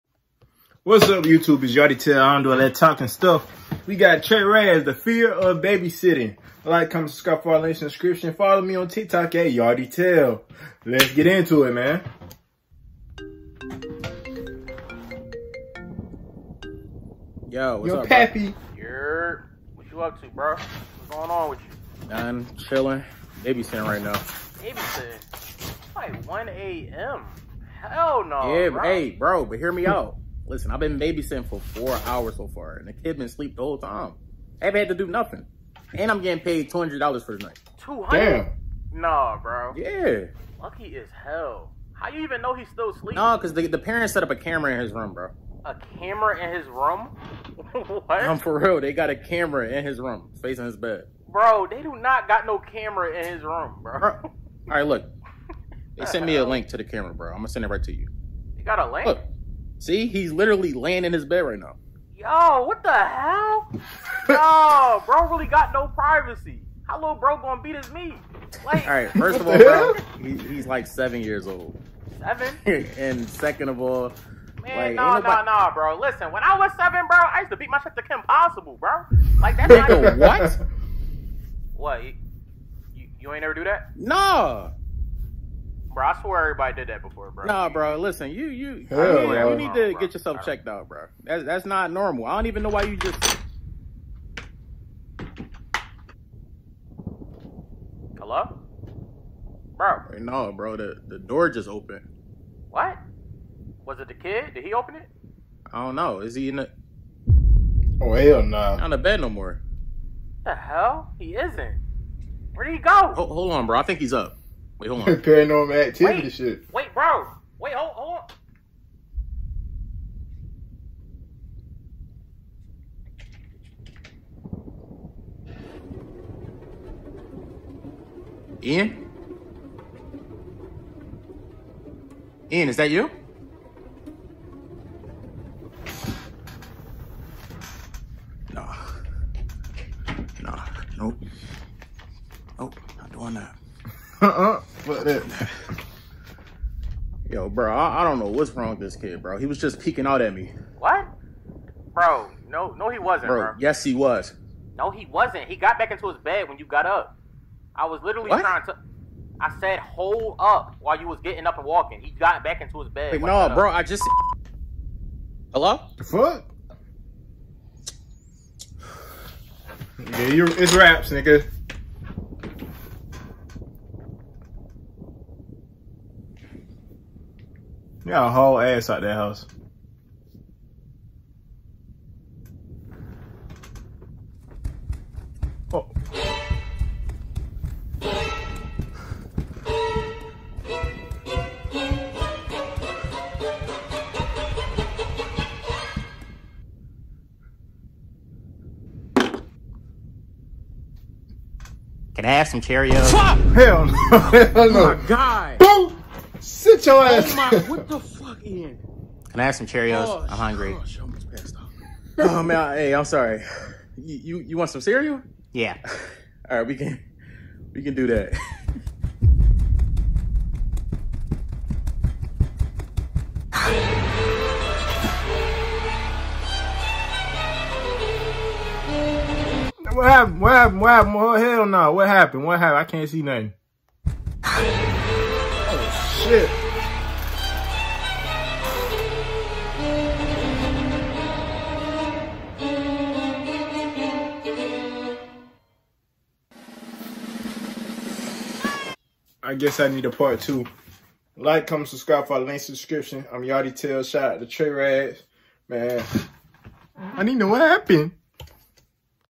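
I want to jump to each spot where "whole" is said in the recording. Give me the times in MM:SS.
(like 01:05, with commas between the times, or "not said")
00:33, 02:58.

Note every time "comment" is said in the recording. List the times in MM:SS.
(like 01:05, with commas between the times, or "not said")
00:06, 04:11.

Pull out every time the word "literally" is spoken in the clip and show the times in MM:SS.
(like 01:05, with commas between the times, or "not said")
01:00, 02:38.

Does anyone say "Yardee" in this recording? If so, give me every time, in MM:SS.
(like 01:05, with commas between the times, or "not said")
00:09, 04:13.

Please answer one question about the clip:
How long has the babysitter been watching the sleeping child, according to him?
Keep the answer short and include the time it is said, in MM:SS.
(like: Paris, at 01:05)
4 hours, at 00:31.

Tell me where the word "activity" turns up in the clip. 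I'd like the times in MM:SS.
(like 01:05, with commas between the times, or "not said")
01:55.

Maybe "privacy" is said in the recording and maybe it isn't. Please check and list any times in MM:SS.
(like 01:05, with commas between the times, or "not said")
01:05.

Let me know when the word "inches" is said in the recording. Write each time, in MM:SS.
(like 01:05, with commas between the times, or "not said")
not said.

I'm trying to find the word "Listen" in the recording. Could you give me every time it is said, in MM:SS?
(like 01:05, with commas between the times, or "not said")
00:30, 01:15, 01:27.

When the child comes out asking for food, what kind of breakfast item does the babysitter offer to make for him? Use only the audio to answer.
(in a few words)
cereal.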